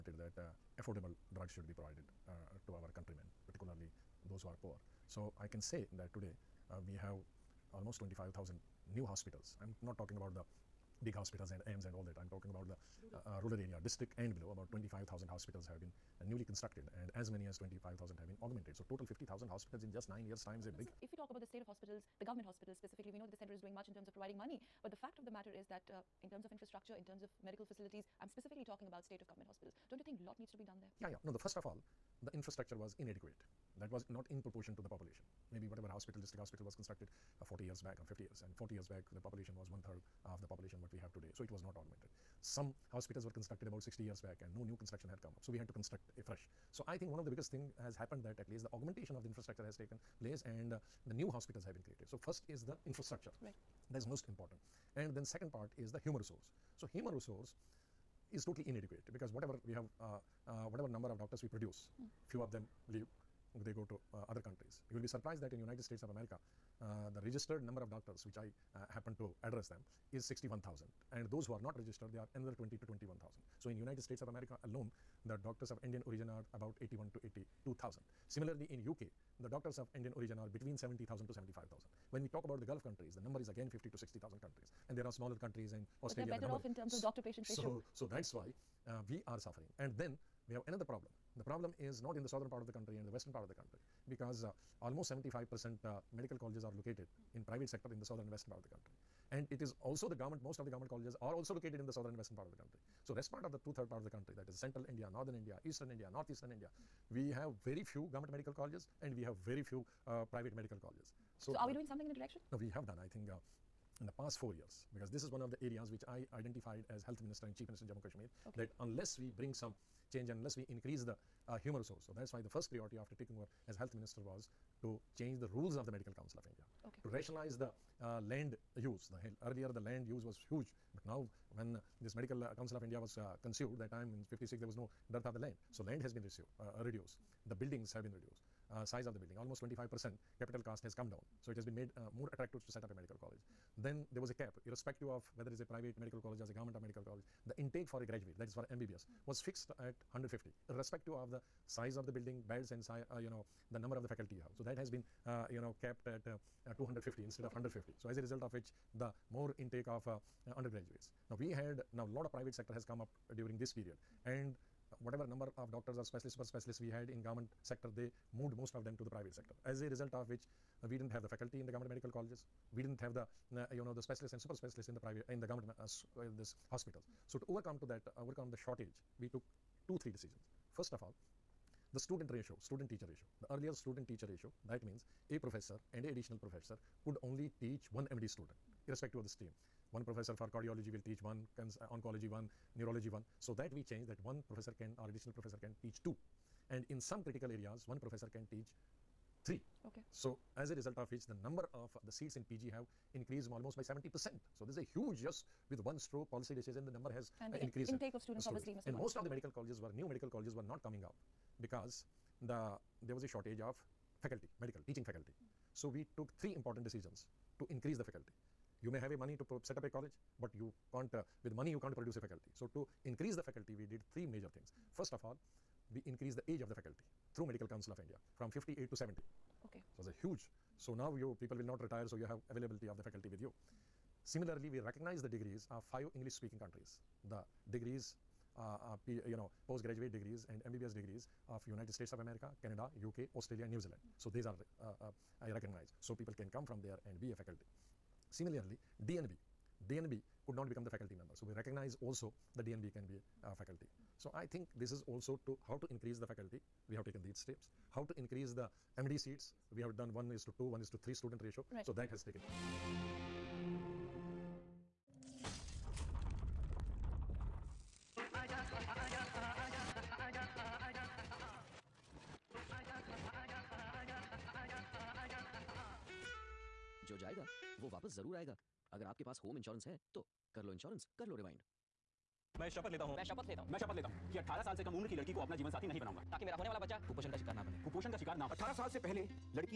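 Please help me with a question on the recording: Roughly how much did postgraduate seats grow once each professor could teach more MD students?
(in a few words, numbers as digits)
70 percent.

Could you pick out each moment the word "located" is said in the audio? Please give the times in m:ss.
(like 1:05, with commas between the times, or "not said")
1:36, 1:41.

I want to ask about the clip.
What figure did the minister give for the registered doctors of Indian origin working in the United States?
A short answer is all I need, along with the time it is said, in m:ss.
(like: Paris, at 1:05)
61,000, at 1:10.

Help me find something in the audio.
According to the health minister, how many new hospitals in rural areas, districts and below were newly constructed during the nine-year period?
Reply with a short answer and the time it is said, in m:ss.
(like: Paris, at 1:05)
25,000, at 0:07.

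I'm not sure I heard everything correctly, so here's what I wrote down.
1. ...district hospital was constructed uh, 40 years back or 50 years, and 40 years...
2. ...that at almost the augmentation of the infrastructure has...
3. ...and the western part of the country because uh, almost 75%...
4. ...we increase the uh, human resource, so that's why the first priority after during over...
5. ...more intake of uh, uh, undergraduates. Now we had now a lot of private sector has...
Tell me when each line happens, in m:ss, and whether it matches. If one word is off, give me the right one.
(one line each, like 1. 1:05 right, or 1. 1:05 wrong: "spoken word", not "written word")
1. 0:36 right
2. 0:48 wrong: "least", not "almost"
3. 1:32 right
4. 2:00 wrong: "taking", not "during"
5. 2:39 right.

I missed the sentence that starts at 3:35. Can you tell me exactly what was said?
So we took three important decisions to increase the faculty.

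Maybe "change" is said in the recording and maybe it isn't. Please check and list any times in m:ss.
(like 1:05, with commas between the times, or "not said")
2:00, 2:05, 3:13.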